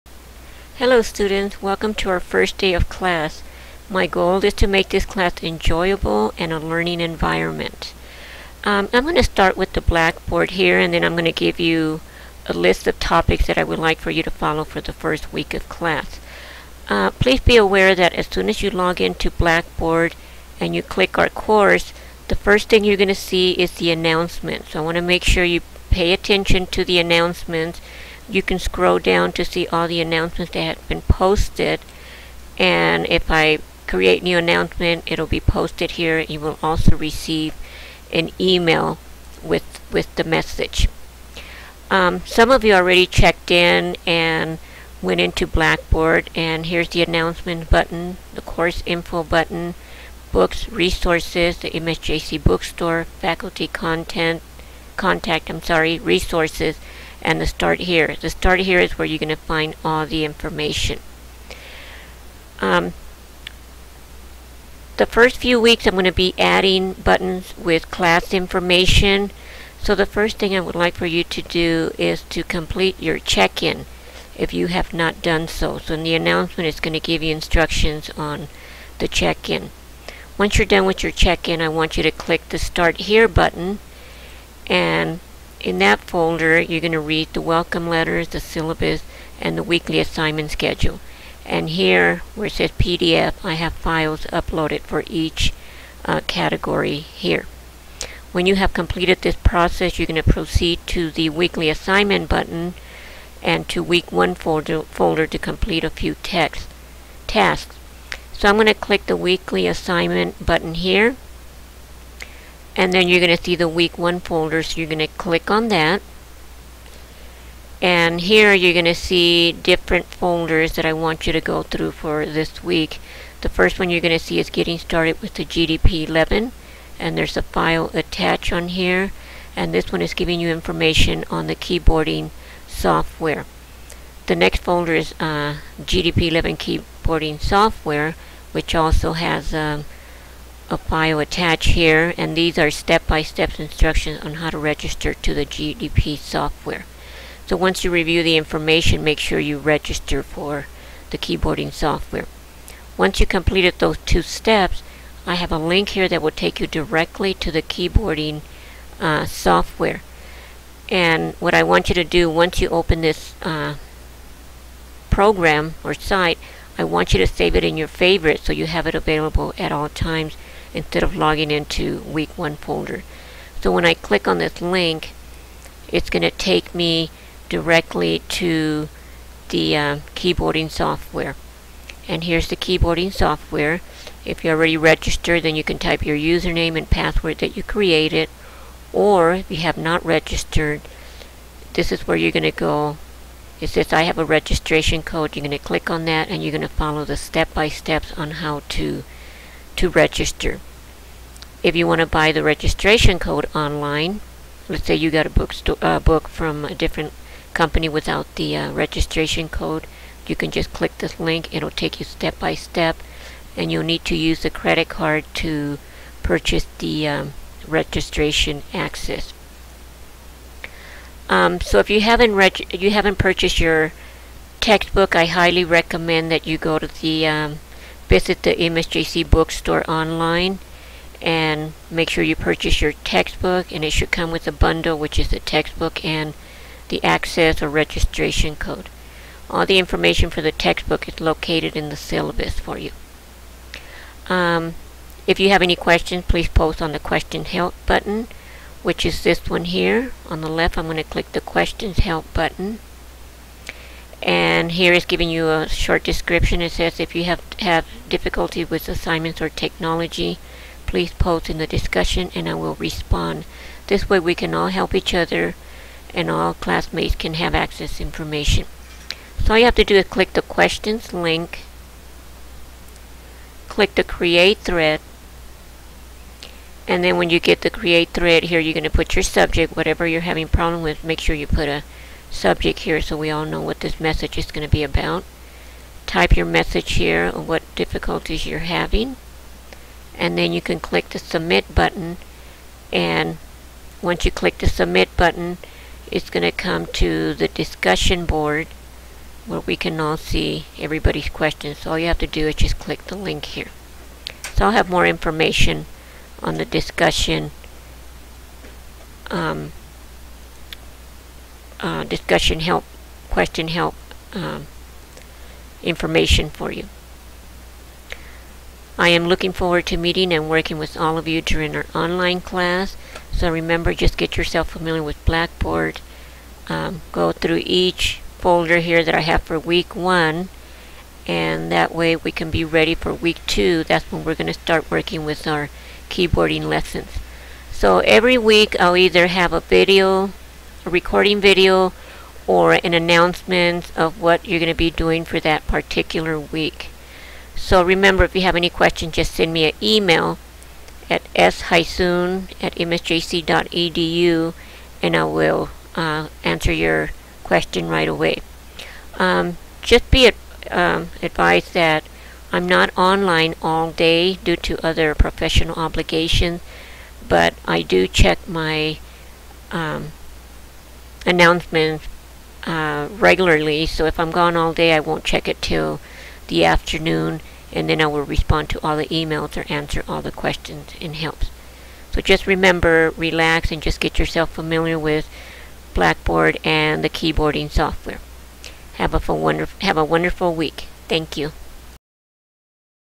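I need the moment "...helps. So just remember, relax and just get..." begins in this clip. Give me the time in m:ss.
6:21.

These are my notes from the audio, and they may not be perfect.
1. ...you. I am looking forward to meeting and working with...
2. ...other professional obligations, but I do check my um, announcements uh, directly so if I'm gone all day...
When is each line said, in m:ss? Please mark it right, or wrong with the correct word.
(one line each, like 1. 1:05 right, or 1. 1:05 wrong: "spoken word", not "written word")
1. 5:16 right
2. 6:04 wrong: "regularly", not "directly".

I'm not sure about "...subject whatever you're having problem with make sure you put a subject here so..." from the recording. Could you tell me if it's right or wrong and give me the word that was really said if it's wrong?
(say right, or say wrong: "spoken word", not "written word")
right.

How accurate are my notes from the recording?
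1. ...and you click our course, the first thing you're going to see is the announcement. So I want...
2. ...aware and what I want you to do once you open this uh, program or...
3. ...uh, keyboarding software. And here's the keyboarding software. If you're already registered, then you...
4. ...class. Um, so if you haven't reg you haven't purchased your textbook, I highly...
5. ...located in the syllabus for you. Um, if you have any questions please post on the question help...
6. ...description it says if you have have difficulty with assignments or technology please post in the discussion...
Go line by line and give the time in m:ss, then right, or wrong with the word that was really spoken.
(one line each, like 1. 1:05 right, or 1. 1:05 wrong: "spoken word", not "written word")
1. 0:20 right
2. 2:39 wrong: "software", not "aware"
3. 2:59 right
4. 3:38 wrong: "access", not "class"
5. 4:01 right
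6. 4:16 right.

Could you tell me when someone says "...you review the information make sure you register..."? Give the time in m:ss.
2:27.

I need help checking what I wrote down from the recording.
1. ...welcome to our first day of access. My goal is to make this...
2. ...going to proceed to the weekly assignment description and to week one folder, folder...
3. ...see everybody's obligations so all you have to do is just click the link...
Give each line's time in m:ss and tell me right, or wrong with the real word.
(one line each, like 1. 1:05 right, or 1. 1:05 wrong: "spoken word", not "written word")
1. 0:01 wrong: "class", not "access"
2. 1:40 wrong: "button", not "description"
3. 5:00 wrong: "questions", not "obligations".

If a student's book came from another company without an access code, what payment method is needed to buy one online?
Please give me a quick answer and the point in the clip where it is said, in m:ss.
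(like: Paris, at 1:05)
credit card, at 3:34.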